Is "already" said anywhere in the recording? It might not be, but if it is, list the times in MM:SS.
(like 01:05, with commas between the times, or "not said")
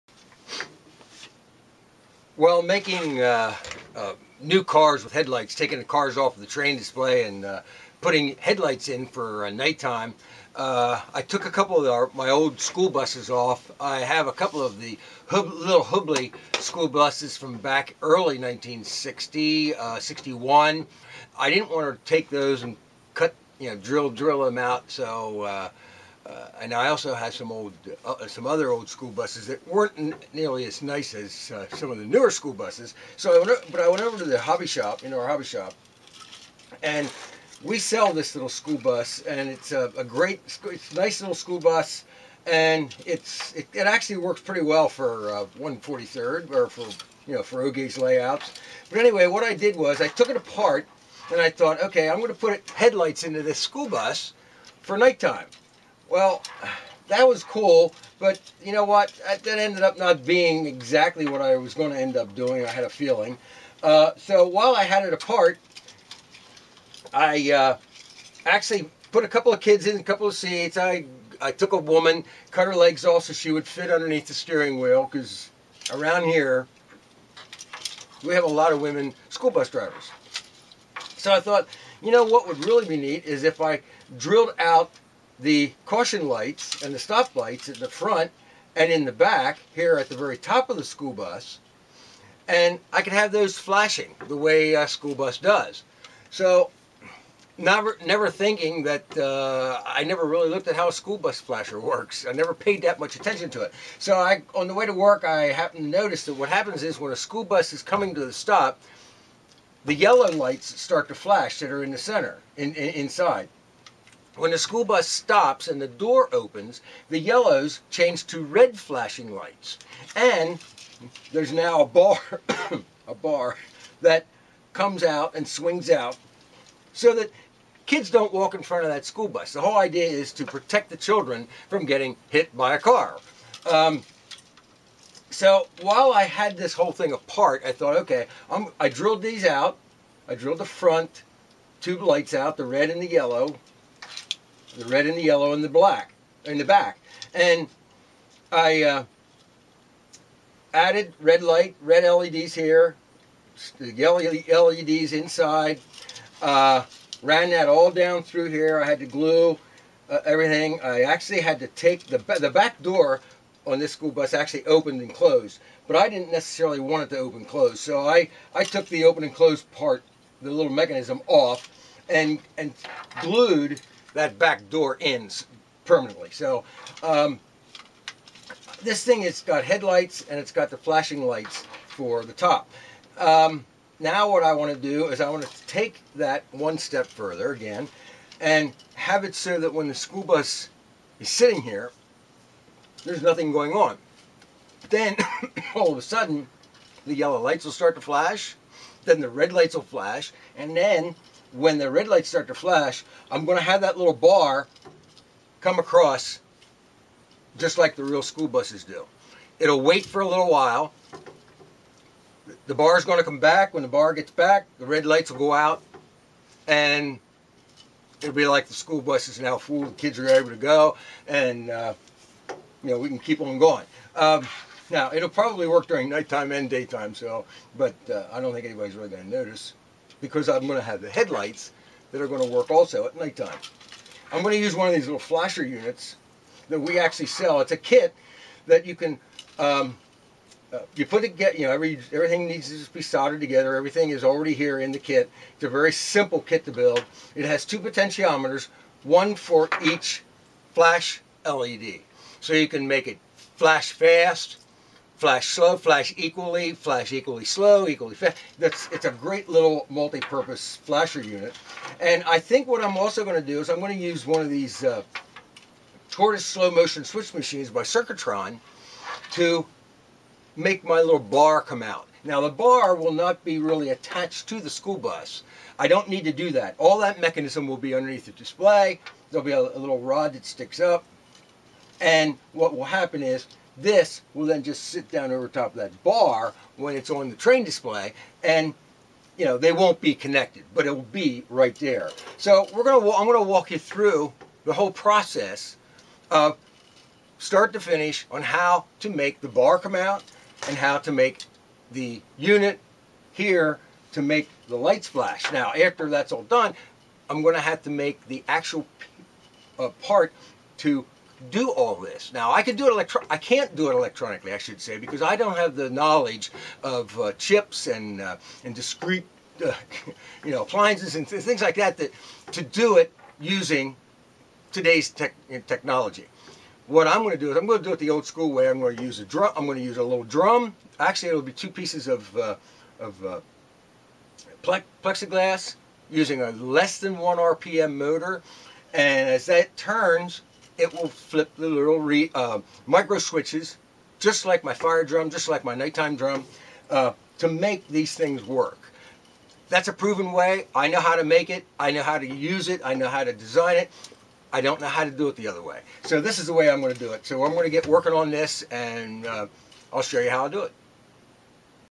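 04:04.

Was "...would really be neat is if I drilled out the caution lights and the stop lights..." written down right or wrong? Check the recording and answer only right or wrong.
right.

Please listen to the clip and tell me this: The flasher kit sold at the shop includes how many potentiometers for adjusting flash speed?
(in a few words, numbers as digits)
2.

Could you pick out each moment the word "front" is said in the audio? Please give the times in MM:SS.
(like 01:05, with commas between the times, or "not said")
01:27, 02:08, 02:20.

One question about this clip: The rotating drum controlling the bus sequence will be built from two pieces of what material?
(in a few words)
Plexiglass.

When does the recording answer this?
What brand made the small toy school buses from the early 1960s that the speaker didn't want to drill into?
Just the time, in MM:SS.
00:15.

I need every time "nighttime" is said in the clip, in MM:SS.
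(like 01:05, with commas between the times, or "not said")
00:09, 00:54, 03:46, 03:53, 05:45.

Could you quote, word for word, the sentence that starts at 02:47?
So I I took the open and close part, the little mechanism off, and and glued that back door ends permanently.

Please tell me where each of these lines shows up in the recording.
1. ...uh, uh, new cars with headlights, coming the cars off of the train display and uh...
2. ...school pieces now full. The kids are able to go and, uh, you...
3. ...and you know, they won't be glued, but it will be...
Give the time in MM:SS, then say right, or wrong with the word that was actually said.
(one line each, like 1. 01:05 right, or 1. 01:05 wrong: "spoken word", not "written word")
1. 00:03 wrong: "taking", not "coming"
2. 03:38 wrong: "buses", not "pieces"
3. 04:48 wrong: "connected", not "glued".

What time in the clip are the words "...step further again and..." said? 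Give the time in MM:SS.
03:06.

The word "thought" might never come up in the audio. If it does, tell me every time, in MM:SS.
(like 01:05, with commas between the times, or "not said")
00:51, 01:21, 02:17.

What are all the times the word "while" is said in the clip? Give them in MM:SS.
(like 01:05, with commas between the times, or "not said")
01:04, 02:15, 03:30.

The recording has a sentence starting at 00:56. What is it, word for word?
Well, that was cool, but you know what?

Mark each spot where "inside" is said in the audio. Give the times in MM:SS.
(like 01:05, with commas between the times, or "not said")
01:52, 02:35.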